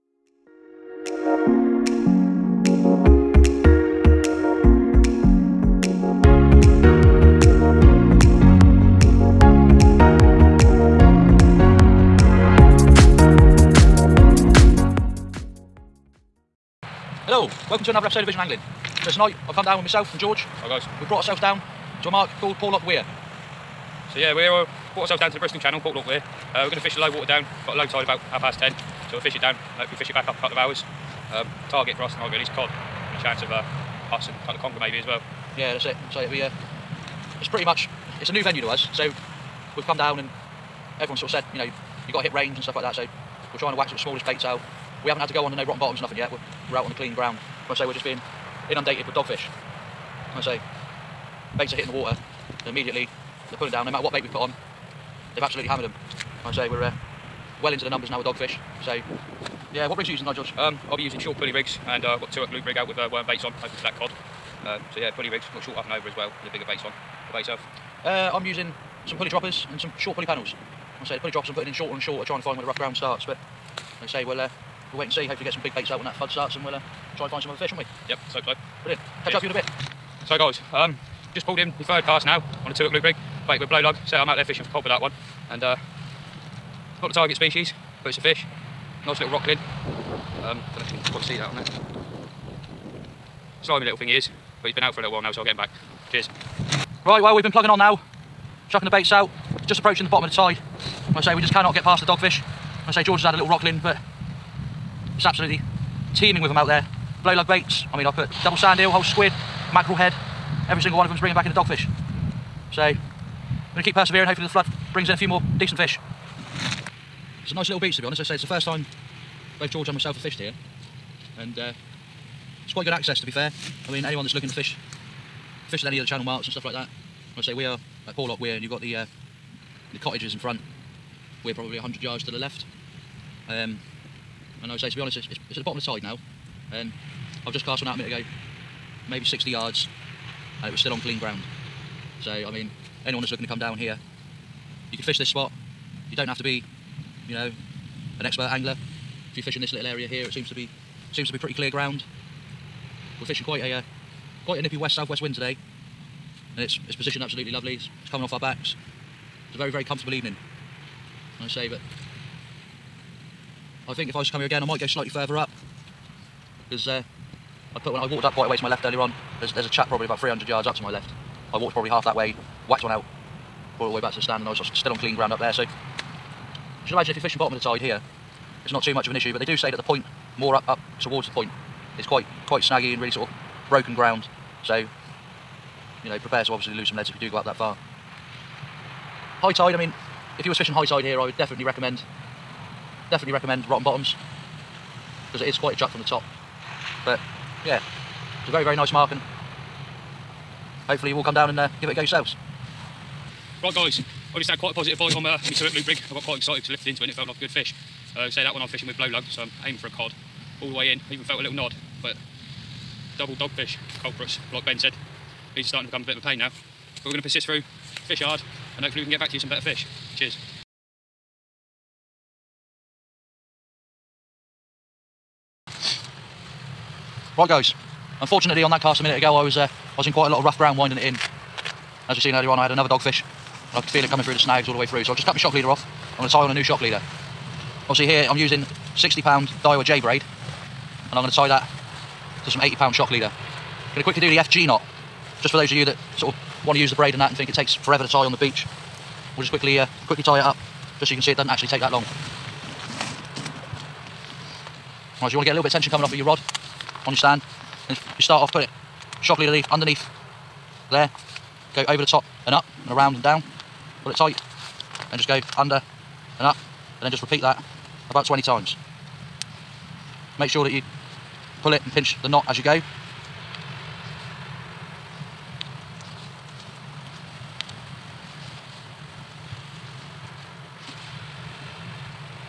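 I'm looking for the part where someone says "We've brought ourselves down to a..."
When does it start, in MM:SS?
00:21.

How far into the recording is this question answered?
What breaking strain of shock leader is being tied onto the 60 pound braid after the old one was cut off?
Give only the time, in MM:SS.
04:02.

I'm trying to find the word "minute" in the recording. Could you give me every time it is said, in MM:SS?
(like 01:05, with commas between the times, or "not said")
02:17, 03:49.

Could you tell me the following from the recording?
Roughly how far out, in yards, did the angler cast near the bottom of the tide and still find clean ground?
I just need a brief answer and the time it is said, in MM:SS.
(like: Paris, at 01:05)
60 yards, at 02:19.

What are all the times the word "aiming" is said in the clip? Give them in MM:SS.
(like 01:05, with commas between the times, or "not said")
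03:29.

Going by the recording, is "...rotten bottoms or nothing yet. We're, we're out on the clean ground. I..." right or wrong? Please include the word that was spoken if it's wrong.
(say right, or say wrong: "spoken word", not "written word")
right.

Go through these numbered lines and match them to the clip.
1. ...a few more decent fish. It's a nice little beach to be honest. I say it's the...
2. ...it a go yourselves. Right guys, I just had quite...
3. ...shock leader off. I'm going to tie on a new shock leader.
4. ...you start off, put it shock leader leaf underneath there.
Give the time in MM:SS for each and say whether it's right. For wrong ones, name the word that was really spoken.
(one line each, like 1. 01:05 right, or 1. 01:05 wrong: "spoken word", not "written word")
1. 01:55 right
2. 03:21 right
3. 03:55 right
4. 04:18 right.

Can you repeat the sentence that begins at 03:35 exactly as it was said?
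These are starting to become a bit of a pain now.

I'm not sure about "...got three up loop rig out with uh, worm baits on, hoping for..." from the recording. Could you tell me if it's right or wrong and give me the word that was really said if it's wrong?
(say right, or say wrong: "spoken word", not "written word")
wrong: "two", not "three".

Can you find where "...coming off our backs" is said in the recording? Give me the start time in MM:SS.
02:38.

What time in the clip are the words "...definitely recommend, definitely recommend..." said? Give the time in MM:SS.
03:11.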